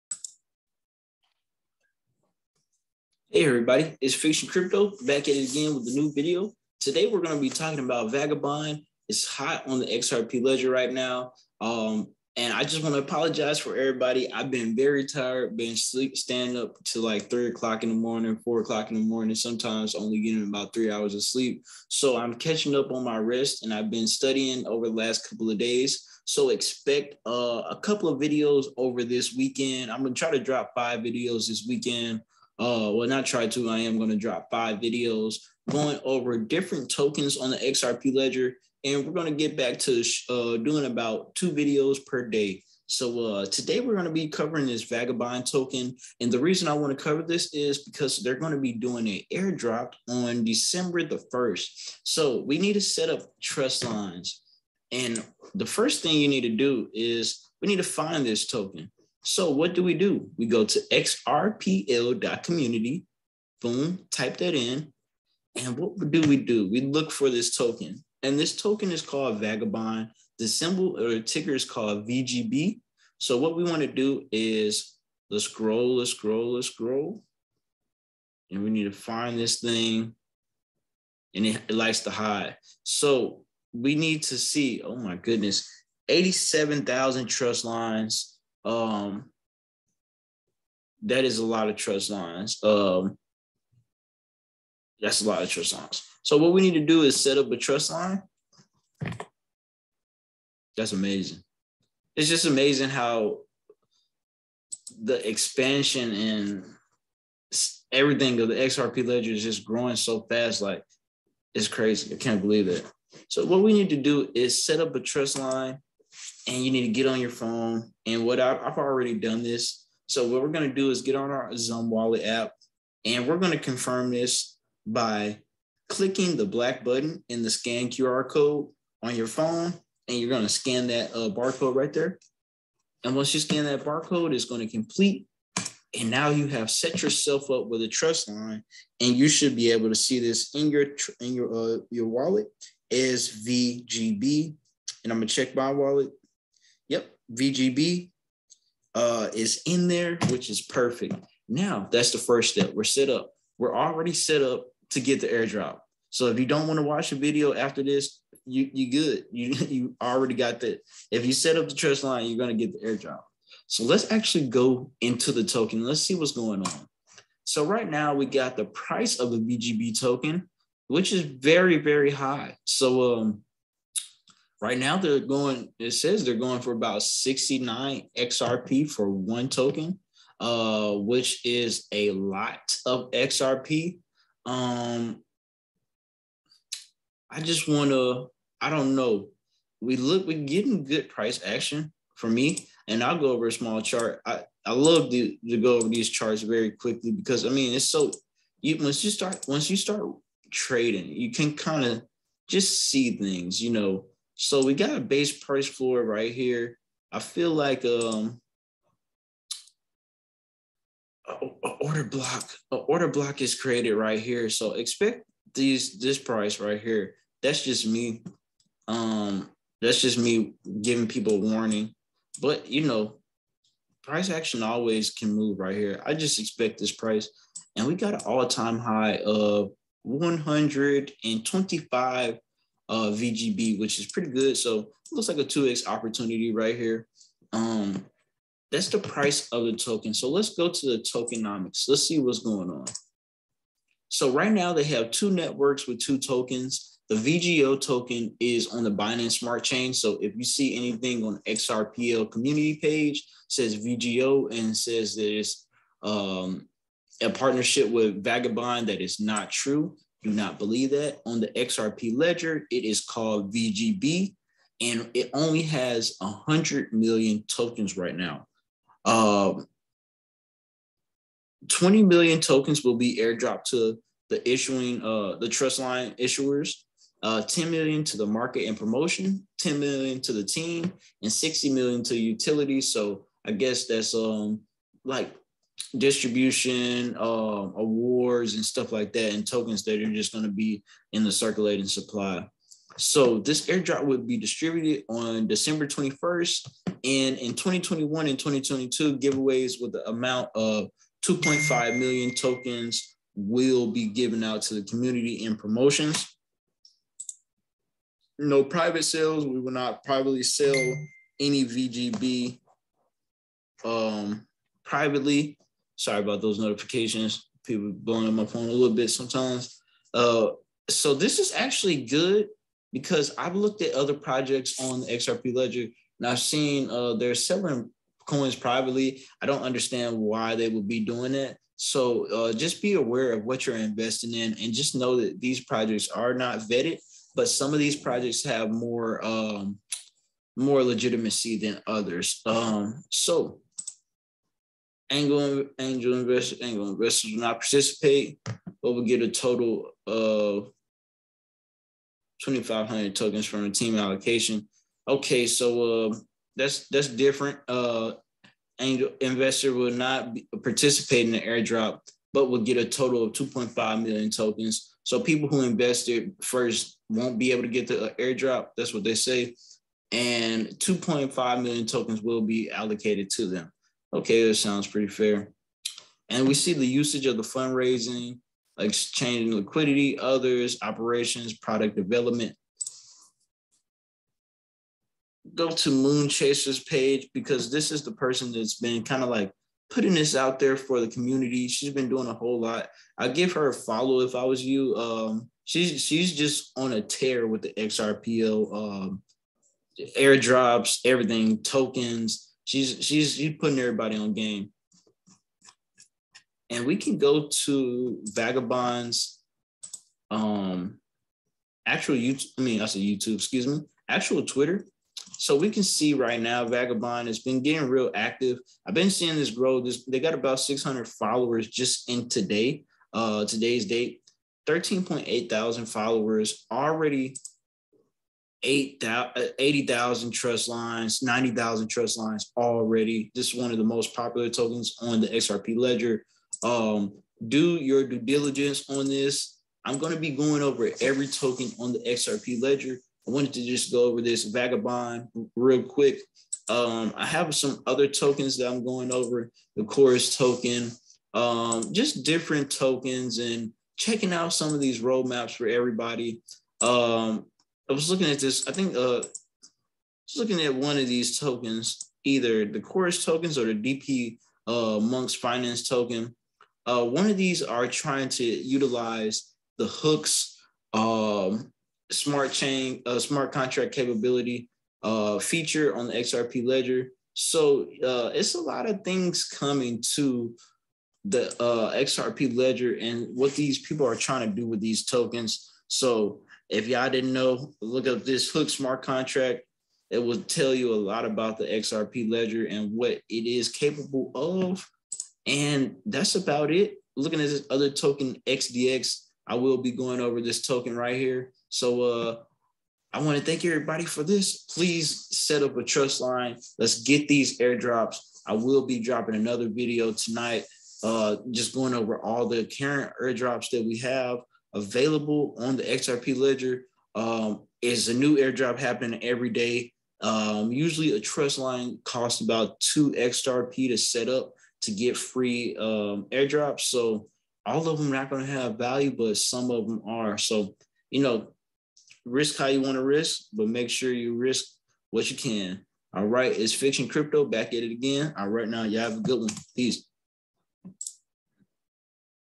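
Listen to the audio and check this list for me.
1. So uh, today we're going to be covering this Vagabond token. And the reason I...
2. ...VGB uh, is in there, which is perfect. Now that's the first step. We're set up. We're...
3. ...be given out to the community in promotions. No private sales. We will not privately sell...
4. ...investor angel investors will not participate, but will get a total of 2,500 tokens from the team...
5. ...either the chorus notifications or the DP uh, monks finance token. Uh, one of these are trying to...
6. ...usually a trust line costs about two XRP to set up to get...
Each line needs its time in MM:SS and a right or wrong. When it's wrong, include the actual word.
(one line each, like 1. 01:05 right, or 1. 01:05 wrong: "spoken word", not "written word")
1. 00:42 right
2. 02:27 right
3. 05:03 right
4. 05:45 right
5. 07:42 wrong: "tokens", not "notifications"
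6. 08:40 right.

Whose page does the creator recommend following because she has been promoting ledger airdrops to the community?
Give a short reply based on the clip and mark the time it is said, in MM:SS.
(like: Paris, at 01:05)
Moon Chaser, at 06:25.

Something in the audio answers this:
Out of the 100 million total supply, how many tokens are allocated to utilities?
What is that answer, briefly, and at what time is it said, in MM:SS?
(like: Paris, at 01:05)
60 million, at 04:41.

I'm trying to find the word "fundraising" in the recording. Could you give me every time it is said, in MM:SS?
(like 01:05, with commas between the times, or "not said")
06:17.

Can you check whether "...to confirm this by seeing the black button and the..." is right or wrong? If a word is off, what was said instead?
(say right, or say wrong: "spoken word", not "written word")
wrong: "clicking", not "seeing".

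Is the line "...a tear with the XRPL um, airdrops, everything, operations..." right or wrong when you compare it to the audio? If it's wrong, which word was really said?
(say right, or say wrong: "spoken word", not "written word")
wrong: "tokens", not "operations".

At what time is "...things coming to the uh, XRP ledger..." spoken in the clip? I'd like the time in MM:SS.
07:59.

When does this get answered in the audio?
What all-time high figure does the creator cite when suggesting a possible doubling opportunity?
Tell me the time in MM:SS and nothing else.
03:50.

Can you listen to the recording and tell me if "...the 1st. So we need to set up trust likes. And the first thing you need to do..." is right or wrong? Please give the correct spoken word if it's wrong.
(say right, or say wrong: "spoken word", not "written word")
wrong: "lines", not "likes".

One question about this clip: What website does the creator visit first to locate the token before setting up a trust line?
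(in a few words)
xrpl.community.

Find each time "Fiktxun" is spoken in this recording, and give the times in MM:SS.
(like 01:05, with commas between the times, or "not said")
00:04, 08:56.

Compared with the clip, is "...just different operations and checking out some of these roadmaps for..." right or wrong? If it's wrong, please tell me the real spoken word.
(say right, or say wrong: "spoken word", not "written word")
wrong: "tokens", not "operations".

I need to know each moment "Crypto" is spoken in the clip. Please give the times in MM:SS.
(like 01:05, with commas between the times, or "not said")
00:04, 08:57.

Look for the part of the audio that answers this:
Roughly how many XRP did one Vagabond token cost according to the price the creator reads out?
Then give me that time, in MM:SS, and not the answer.
02:57.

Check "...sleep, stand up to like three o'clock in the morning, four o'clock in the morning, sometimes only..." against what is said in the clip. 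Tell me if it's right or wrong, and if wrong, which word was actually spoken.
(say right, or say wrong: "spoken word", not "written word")
right.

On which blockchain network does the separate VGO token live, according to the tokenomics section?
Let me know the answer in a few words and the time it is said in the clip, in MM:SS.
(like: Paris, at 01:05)
Binance Smart Chain, at 04:08.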